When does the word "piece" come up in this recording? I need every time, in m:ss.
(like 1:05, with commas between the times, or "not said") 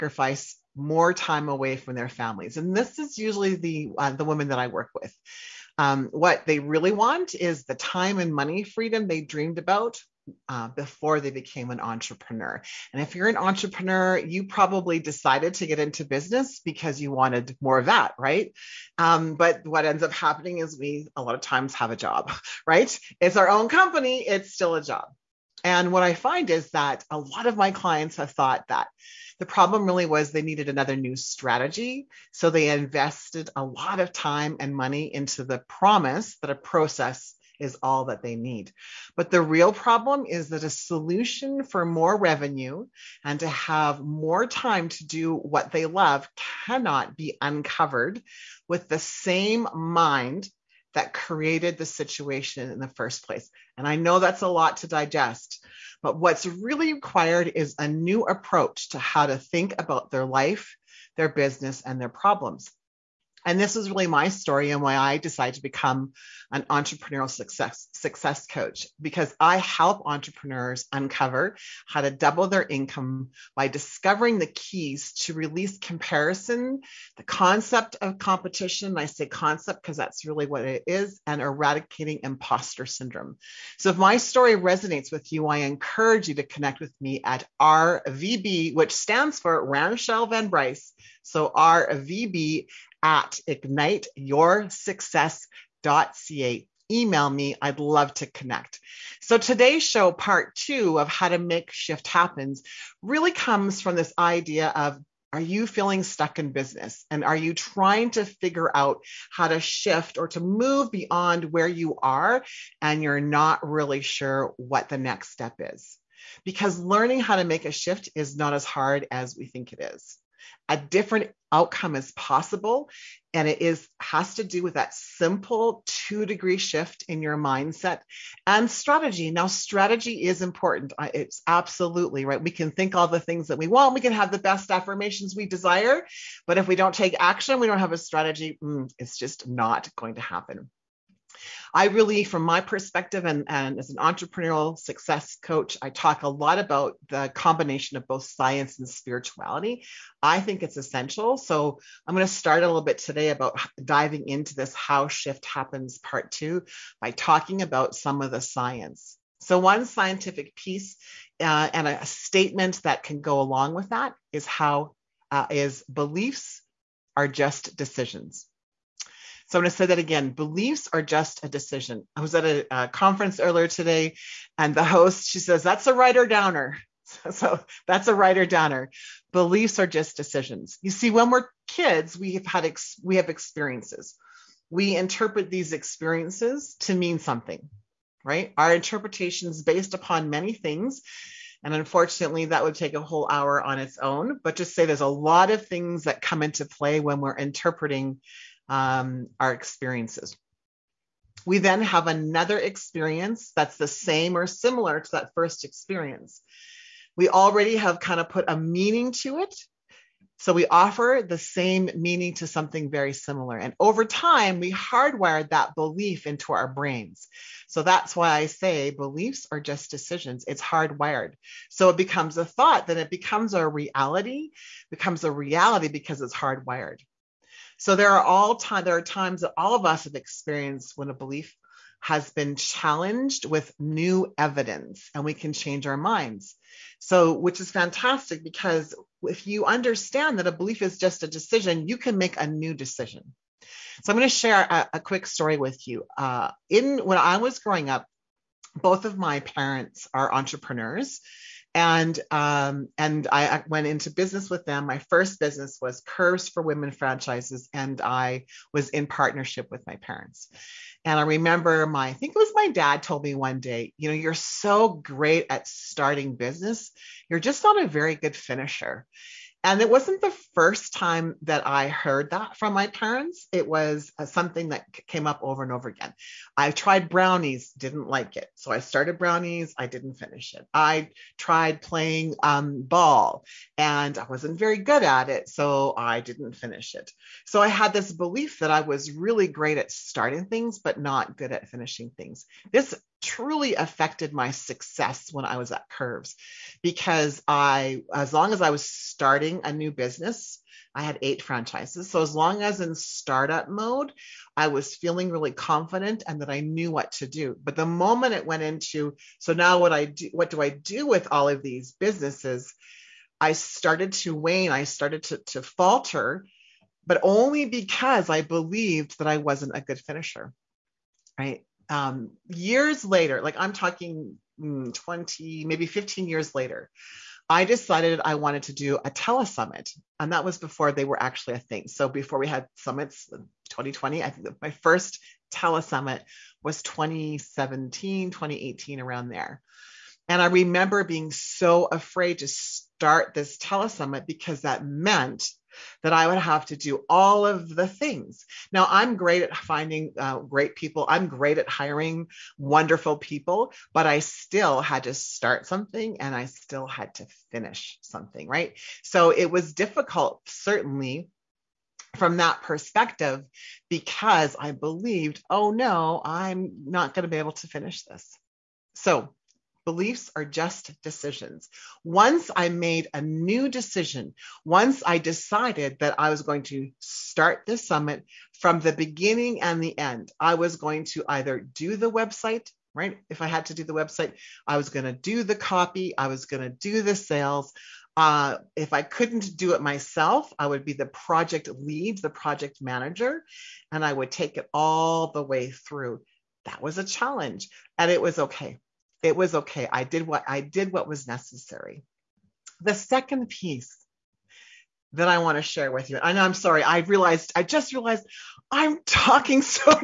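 2:40, 6:43.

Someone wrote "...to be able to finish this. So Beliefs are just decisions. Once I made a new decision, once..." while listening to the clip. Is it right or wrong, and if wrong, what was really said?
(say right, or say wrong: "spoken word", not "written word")
right.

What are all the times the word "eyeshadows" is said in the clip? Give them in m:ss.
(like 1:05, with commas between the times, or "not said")
not said.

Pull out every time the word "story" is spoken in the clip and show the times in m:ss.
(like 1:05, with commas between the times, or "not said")
1:04, 1:24, 4:05.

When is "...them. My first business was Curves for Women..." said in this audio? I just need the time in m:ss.
4:14.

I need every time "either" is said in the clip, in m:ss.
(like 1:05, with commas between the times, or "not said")
6:21.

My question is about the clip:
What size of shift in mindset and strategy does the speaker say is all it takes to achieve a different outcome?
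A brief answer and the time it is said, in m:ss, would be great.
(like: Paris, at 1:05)
2 degree, at 2:06.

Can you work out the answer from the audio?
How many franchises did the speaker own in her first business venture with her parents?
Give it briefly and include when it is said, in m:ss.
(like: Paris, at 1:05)
8, at 5:01.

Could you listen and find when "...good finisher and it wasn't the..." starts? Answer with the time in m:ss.
4:28.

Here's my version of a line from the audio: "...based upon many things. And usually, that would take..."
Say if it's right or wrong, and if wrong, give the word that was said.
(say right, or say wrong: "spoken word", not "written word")
wrong: "unfortunately", not "usually".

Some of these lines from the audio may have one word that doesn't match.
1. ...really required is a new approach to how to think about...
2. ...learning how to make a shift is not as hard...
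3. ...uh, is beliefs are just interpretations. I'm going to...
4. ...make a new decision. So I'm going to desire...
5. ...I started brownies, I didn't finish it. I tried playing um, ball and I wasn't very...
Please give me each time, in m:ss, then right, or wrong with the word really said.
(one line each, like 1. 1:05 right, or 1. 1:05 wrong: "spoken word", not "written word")
1. 0:56 right
2. 1:56 right
3. 2:45 wrong: "decisions", not "interpretations"
4. 4:02 wrong: "share", not "desire"
5. 4:38 right.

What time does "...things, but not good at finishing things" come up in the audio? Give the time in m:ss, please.
4:50.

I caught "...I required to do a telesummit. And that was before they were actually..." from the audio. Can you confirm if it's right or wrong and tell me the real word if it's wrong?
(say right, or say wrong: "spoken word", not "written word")
wrong: "wanted", not "required".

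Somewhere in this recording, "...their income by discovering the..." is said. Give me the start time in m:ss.
1:12.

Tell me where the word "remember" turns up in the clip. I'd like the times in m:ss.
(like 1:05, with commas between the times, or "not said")
4:21, 5:40.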